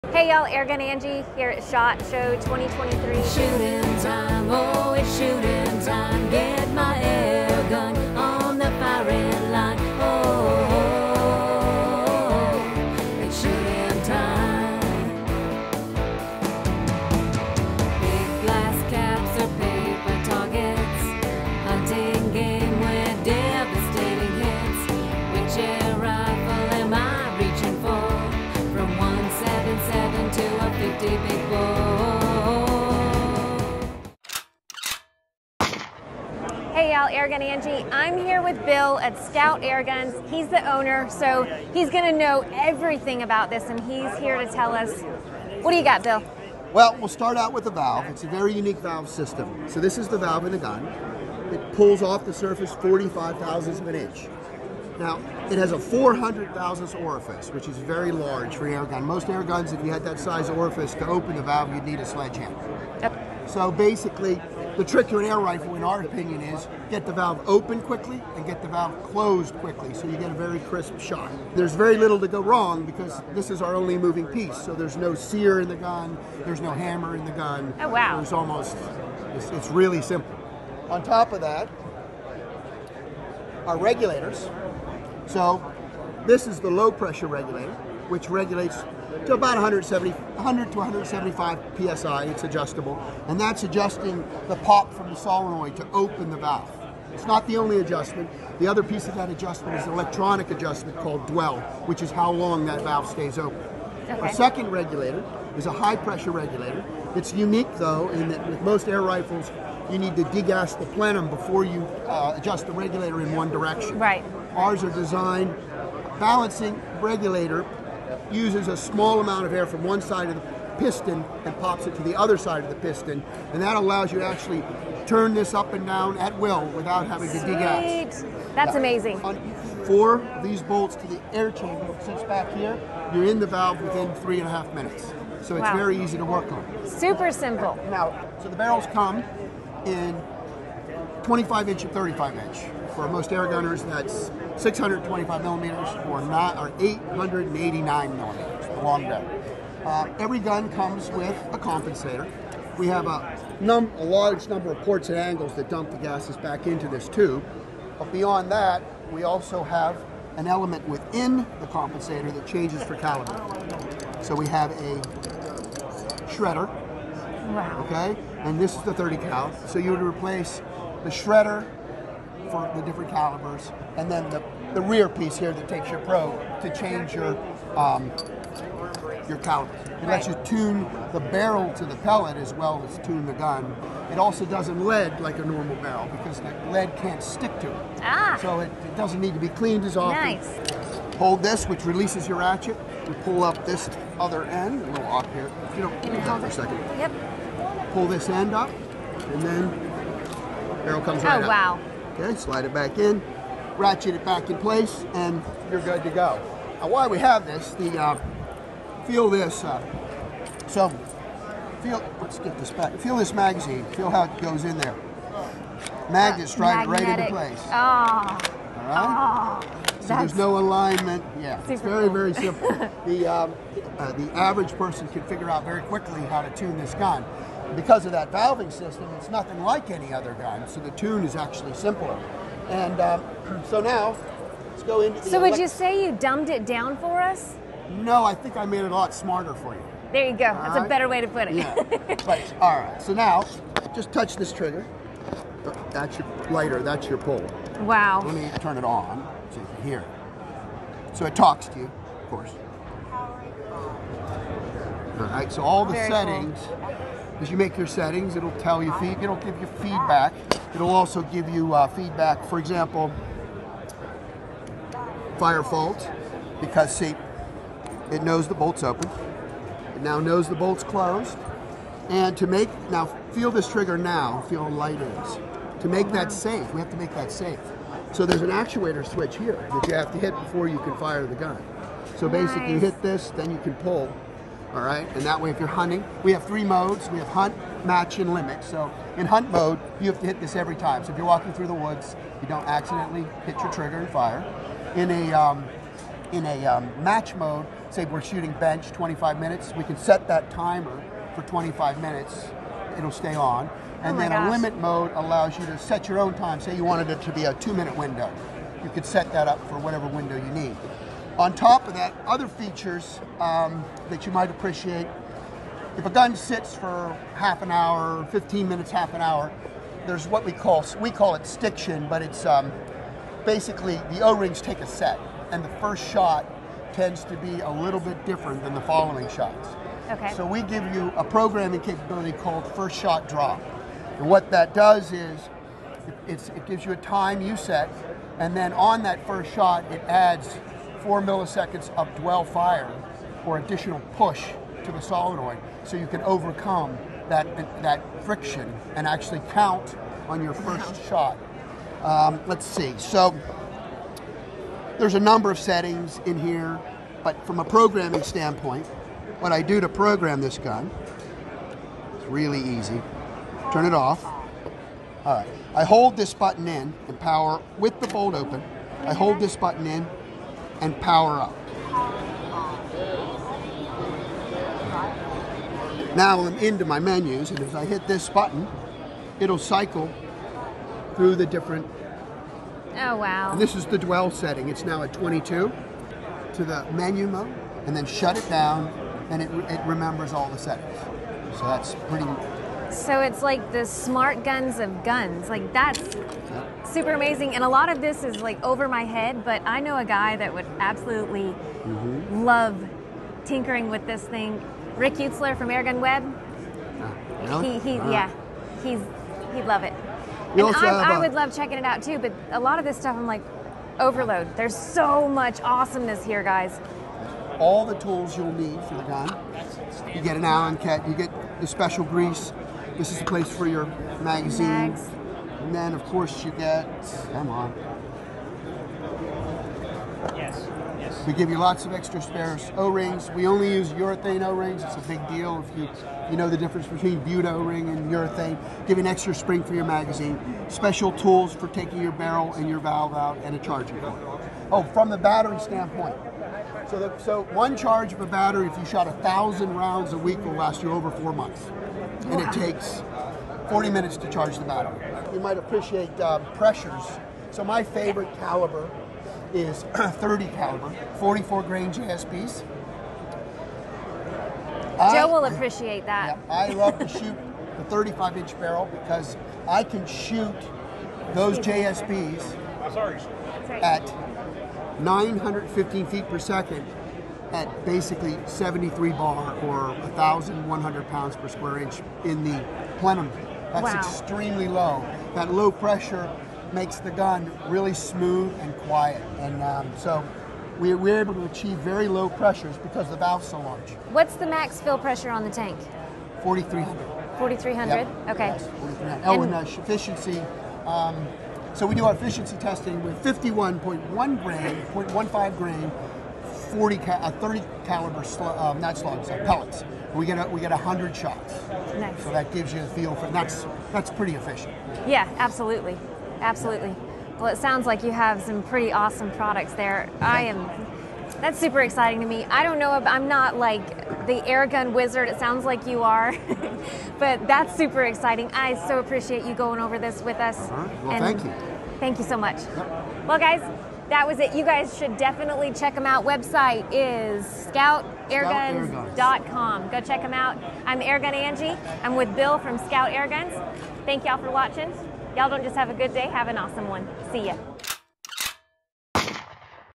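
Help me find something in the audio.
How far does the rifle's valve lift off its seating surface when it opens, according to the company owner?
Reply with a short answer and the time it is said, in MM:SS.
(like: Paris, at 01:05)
45 thousandths of an inch, at 00:52.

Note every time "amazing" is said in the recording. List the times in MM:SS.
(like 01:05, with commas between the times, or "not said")
02:08, 06:37.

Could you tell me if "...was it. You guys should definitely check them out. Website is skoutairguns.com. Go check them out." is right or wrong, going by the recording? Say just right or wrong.
right.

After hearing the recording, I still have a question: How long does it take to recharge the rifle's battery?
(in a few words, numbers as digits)
40 minutes.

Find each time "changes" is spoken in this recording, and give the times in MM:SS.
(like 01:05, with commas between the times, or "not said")
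02:42, 02:56.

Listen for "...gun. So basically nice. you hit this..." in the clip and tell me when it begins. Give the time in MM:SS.
04:41.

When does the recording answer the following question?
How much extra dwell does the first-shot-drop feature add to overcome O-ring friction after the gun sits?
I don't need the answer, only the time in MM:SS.
05:41.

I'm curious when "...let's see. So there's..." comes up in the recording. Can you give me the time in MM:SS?
05:52.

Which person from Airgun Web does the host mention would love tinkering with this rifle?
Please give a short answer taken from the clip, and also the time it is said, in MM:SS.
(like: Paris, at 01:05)
Rick Utzler, at 06:44.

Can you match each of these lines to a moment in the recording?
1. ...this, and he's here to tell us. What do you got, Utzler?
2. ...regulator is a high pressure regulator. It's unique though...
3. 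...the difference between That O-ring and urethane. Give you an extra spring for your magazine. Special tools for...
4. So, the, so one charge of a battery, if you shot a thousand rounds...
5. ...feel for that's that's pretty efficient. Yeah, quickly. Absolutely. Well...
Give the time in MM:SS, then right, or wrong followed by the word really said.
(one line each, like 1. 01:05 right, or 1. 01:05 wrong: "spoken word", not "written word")
1. 00:43 wrong: "Bill", not "Utzler"
2. 01:44 right
3. 07:16 wrong: "Buna", not "That"
4. 07:26 right
5. 08:32 wrong: "absolutely", not "quickly".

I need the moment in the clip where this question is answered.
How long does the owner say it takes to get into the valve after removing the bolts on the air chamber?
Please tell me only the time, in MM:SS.
02:14.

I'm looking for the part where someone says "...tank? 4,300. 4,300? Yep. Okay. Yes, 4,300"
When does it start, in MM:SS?
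08:15.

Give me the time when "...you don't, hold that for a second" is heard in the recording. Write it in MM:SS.
03:15.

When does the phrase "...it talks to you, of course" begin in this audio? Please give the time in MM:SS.
04:11.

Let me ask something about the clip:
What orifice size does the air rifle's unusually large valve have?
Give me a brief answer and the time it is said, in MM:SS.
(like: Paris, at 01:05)
400 thousandths, at 00:55.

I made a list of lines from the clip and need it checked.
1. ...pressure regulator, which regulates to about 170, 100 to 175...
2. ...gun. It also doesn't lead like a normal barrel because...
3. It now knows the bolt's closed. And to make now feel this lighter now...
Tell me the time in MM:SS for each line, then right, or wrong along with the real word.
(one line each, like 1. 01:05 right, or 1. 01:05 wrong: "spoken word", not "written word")
1. 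01:26 right
2. 03:03 right
3. 04:29 wrong: "trigger", not "lighter".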